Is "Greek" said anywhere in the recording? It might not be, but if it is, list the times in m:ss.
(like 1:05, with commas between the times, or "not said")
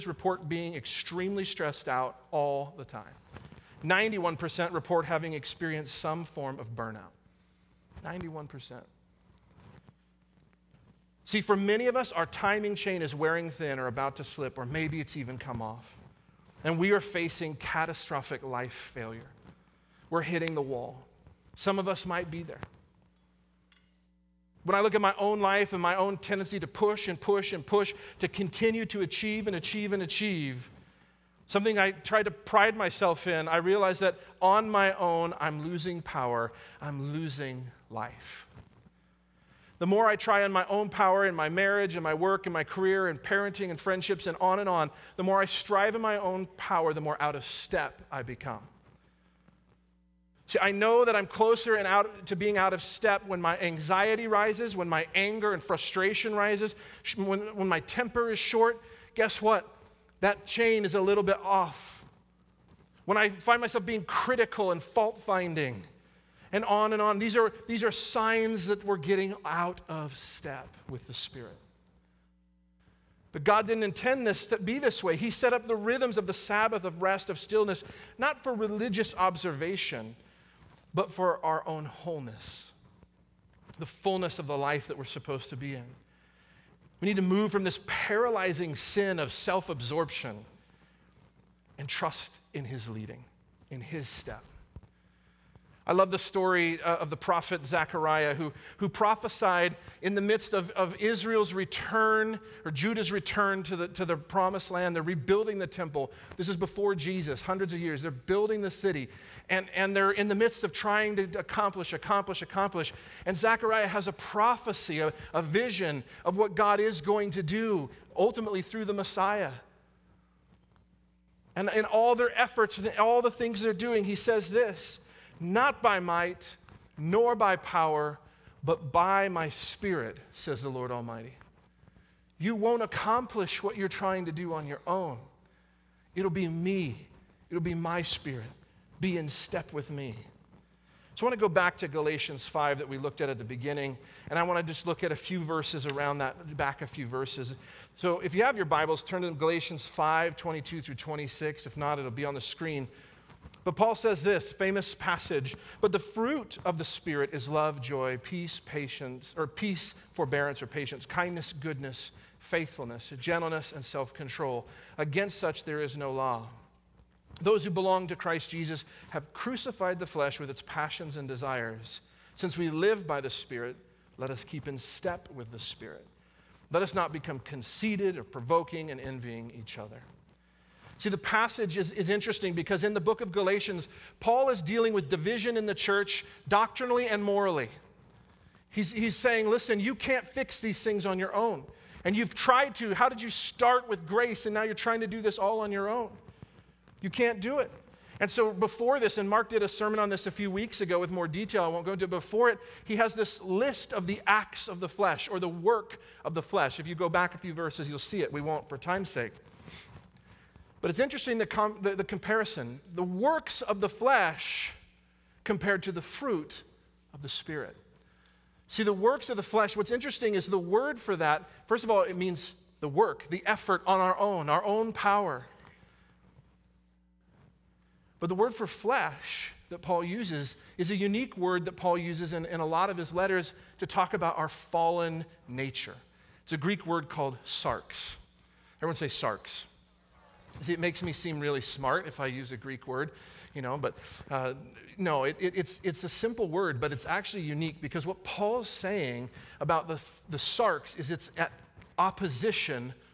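3:56, 4:02.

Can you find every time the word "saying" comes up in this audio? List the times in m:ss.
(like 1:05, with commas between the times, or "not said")
3:09, 4:08.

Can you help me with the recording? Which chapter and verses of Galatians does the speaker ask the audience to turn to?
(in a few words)
Galatians 5:22-26.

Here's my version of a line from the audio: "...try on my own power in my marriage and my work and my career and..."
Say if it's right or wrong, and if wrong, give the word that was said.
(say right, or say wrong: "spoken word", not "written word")
right.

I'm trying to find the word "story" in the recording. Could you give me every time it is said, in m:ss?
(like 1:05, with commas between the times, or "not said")
1:36.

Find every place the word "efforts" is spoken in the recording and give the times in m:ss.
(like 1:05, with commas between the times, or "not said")
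2:02, 3:43.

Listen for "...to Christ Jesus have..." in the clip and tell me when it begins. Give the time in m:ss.
2:48.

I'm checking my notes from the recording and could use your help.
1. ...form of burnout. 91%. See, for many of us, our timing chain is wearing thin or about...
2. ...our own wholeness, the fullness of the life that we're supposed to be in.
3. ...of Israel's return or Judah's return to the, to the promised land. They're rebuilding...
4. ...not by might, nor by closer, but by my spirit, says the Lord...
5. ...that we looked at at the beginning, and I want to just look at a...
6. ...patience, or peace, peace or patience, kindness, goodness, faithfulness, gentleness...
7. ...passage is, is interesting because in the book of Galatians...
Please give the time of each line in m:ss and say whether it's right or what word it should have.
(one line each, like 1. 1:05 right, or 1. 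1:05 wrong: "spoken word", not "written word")
1. 0:06 right
2. 1:21 right
3. 1:40 right
4. 2:05 wrong: "power", not "closer"
5. 2:22 right
6. 2:38 wrong: "forbearance", not "peace"
7. 3:01 right.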